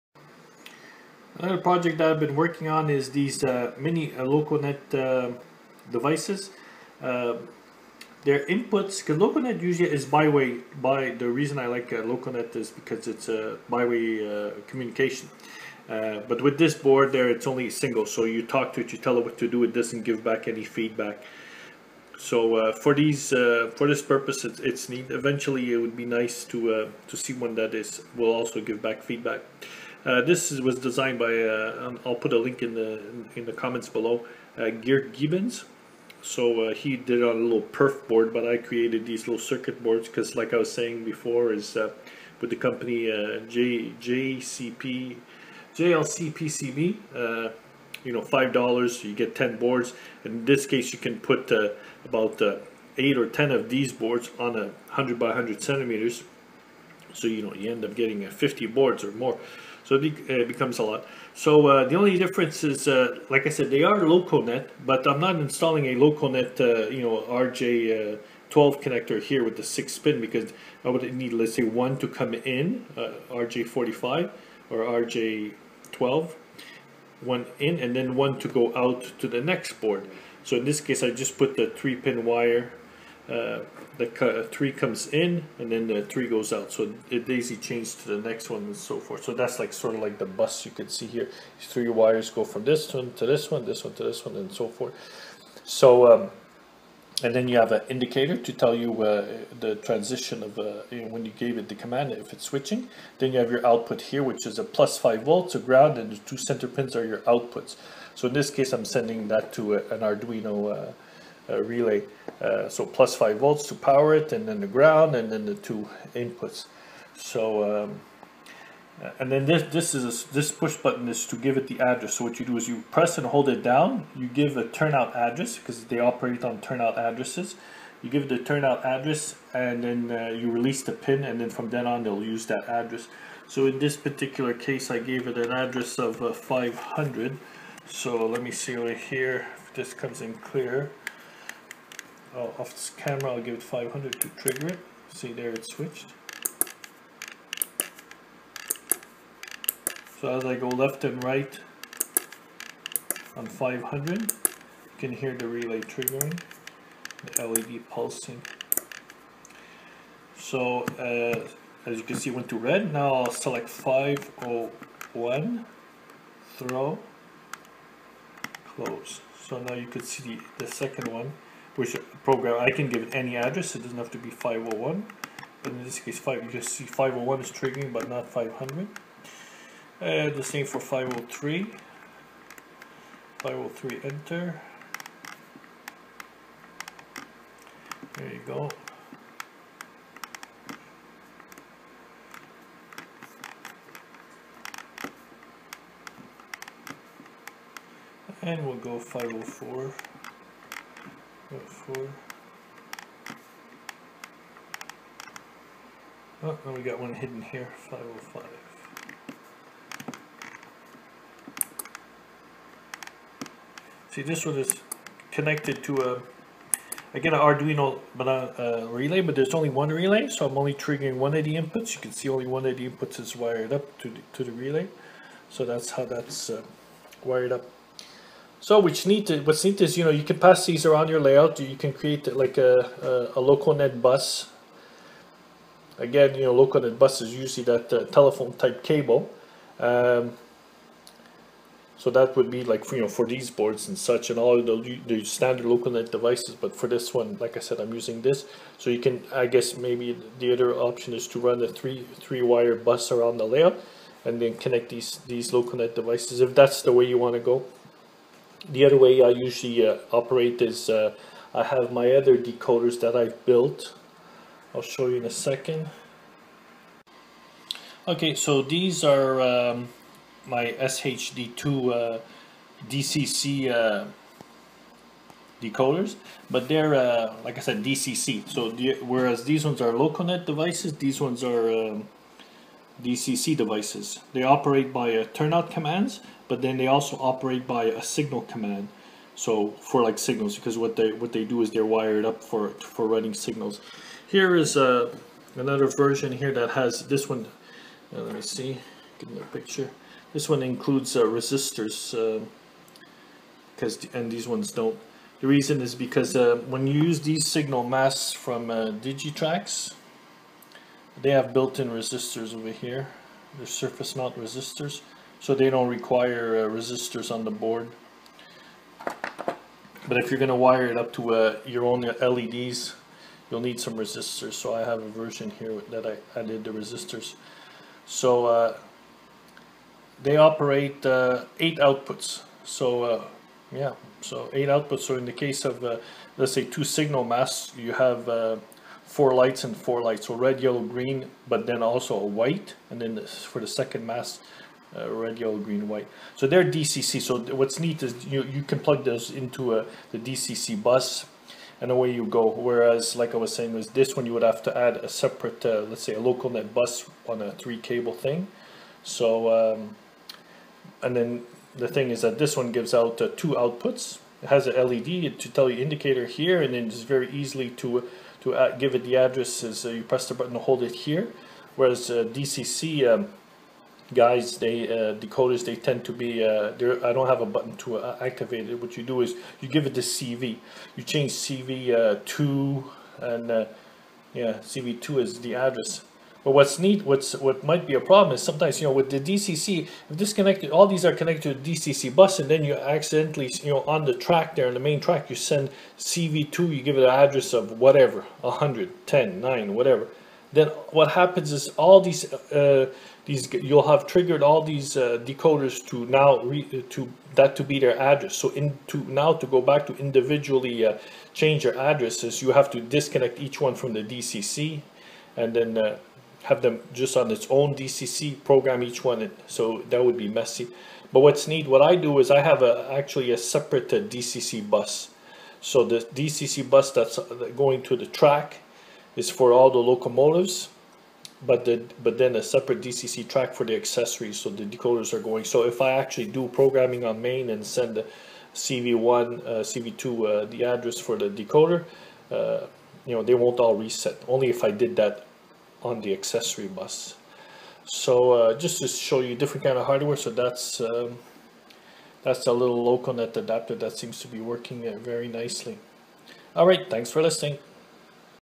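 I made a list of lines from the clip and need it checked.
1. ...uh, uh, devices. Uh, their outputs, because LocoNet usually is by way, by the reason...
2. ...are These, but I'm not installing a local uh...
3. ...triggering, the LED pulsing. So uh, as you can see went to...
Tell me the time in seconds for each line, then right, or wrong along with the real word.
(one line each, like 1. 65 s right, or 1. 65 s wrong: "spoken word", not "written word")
1. 4 s wrong: "inputs", not "outputs"
2. 63 s wrong: "LocoNet", not "These"
3. 155 s right.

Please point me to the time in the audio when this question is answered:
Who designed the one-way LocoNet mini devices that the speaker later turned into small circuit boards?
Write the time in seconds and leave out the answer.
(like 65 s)
34 s.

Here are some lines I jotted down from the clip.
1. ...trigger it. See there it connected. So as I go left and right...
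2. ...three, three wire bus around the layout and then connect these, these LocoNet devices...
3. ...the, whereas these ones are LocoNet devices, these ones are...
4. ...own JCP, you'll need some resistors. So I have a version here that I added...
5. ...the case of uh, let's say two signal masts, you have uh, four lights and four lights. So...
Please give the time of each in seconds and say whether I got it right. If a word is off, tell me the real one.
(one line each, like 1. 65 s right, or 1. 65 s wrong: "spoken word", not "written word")
1. 144 s wrong: "switched", not "connected"
2. 251 s right
3. 278 s right
4. 321 s wrong: "LEDs", not "JCP"
5. 335 s right.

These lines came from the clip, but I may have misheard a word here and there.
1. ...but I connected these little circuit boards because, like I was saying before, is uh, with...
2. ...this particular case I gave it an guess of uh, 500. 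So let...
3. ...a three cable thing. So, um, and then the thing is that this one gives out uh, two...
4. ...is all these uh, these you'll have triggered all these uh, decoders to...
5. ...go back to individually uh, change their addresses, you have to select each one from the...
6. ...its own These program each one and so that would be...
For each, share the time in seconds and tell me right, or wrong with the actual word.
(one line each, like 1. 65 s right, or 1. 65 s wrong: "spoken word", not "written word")
1. 38 s wrong: "created", not "connected"
2. 133 s wrong: "address", not "guess"
3. 357 s right
4. 401 s right
5. 409 s wrong: "disconnect", not "select"
6. 417 s wrong: "DCC", not "These".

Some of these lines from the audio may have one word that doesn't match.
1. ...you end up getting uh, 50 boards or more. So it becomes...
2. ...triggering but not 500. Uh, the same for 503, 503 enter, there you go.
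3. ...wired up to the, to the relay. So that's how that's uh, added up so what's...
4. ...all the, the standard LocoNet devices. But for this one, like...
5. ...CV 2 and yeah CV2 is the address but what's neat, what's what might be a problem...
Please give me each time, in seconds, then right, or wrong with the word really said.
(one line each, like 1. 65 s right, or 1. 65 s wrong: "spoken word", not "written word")
1. 57 s right
2. 177 s right
3. 223 s wrong: "wired", not "added"
4. 244 s right
5. 381 s right.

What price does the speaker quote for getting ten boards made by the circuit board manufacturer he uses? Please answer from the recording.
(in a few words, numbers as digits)
$5.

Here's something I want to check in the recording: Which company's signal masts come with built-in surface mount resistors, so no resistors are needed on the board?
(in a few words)
Digitrax.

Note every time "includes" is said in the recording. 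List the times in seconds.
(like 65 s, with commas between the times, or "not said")
300 s.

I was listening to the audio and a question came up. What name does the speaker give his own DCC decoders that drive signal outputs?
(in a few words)
SHD2.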